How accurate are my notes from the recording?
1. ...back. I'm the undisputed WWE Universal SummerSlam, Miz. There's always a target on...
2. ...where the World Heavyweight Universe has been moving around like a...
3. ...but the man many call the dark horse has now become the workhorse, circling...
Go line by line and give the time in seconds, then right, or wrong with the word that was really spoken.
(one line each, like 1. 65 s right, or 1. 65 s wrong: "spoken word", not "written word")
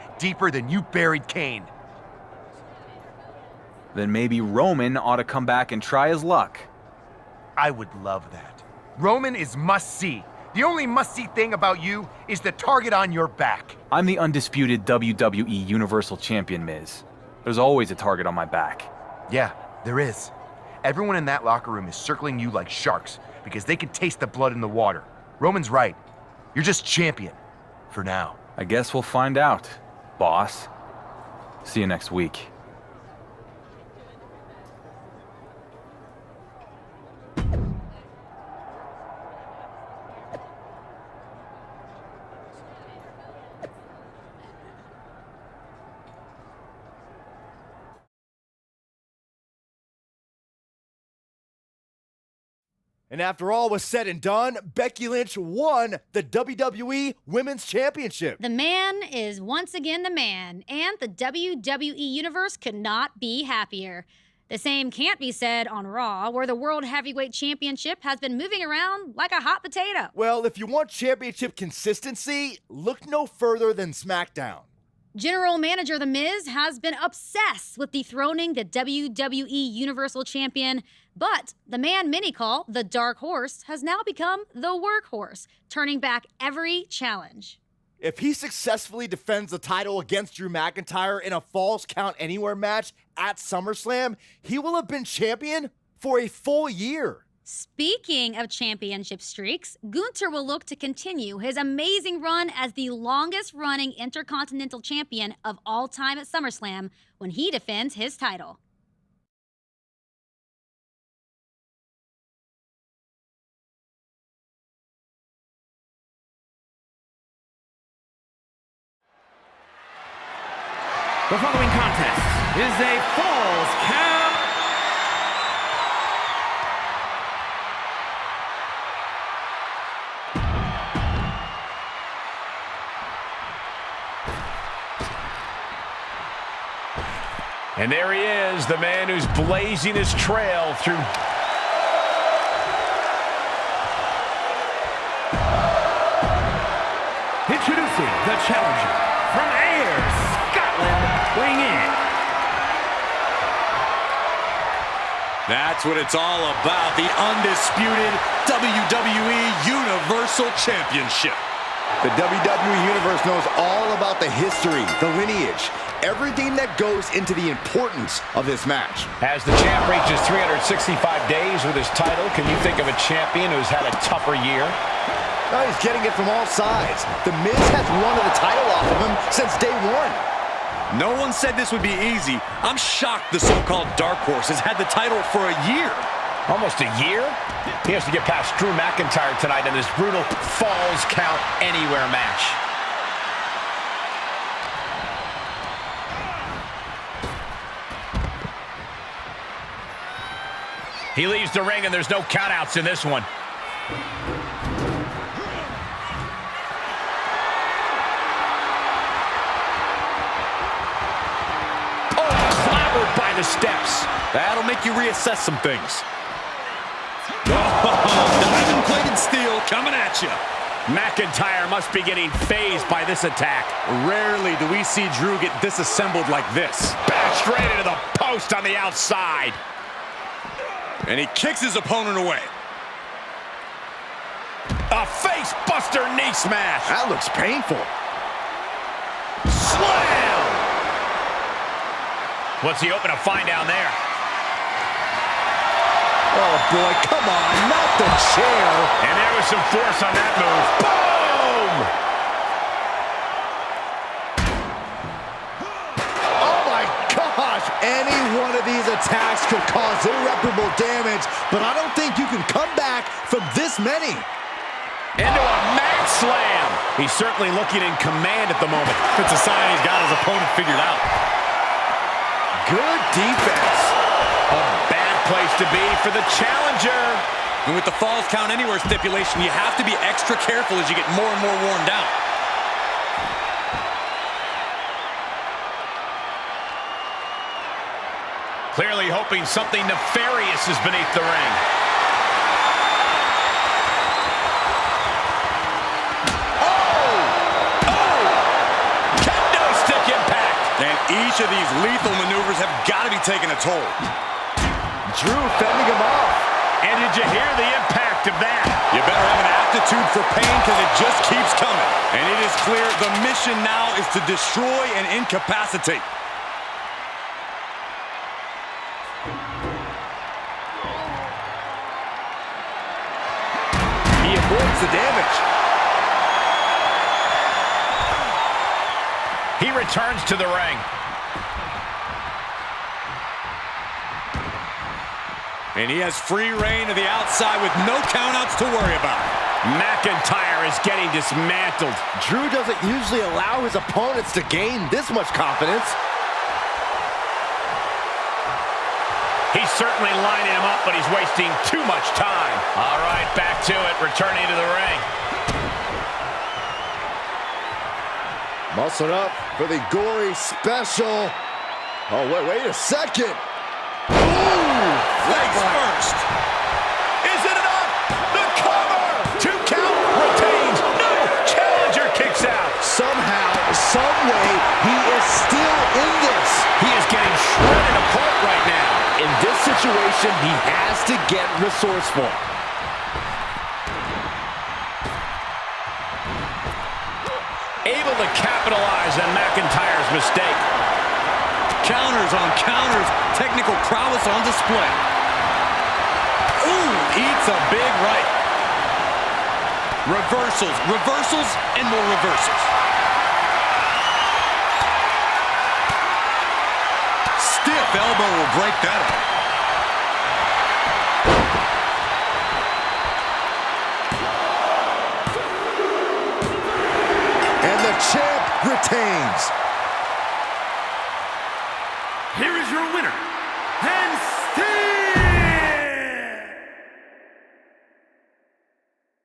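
1. 13 s wrong: "Champion", not "SummerSlam"
2. 66 s wrong: "Championship", not "Universe"
3. 81 s wrong: "turning", not "circling".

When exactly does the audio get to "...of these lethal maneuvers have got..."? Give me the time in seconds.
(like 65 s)
301 s.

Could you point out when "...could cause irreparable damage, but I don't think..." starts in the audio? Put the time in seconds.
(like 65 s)
259 s.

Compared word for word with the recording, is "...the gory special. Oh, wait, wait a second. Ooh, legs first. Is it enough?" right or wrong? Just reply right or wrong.
right.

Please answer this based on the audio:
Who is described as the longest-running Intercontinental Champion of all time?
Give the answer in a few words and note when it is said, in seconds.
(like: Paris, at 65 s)
Gunther, at 99 s.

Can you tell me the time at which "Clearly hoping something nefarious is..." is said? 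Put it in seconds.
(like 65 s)
288 s.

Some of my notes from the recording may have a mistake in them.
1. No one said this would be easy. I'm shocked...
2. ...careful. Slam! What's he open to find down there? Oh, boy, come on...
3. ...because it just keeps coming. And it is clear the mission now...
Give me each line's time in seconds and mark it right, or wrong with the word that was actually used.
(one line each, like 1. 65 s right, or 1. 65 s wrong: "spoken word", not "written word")
1. 180 s right
2. 237 s wrong: "painful", not "careful"
3. 310 s right.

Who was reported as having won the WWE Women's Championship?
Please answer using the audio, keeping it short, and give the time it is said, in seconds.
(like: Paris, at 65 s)
Becky Lynch, at 54 s.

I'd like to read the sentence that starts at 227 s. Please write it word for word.
Back straight into the post on the outside.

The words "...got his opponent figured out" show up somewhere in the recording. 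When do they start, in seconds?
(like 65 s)
269 s.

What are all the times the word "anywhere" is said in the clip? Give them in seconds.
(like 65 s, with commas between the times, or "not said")
92 s, 191 s, 278 s.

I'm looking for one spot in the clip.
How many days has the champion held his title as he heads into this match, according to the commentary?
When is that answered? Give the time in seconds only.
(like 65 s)
170 s.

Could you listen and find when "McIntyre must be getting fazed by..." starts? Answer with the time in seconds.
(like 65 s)
220 s.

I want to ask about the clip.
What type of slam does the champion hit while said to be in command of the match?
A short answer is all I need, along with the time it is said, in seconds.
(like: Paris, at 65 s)
mat slam, at 265 s.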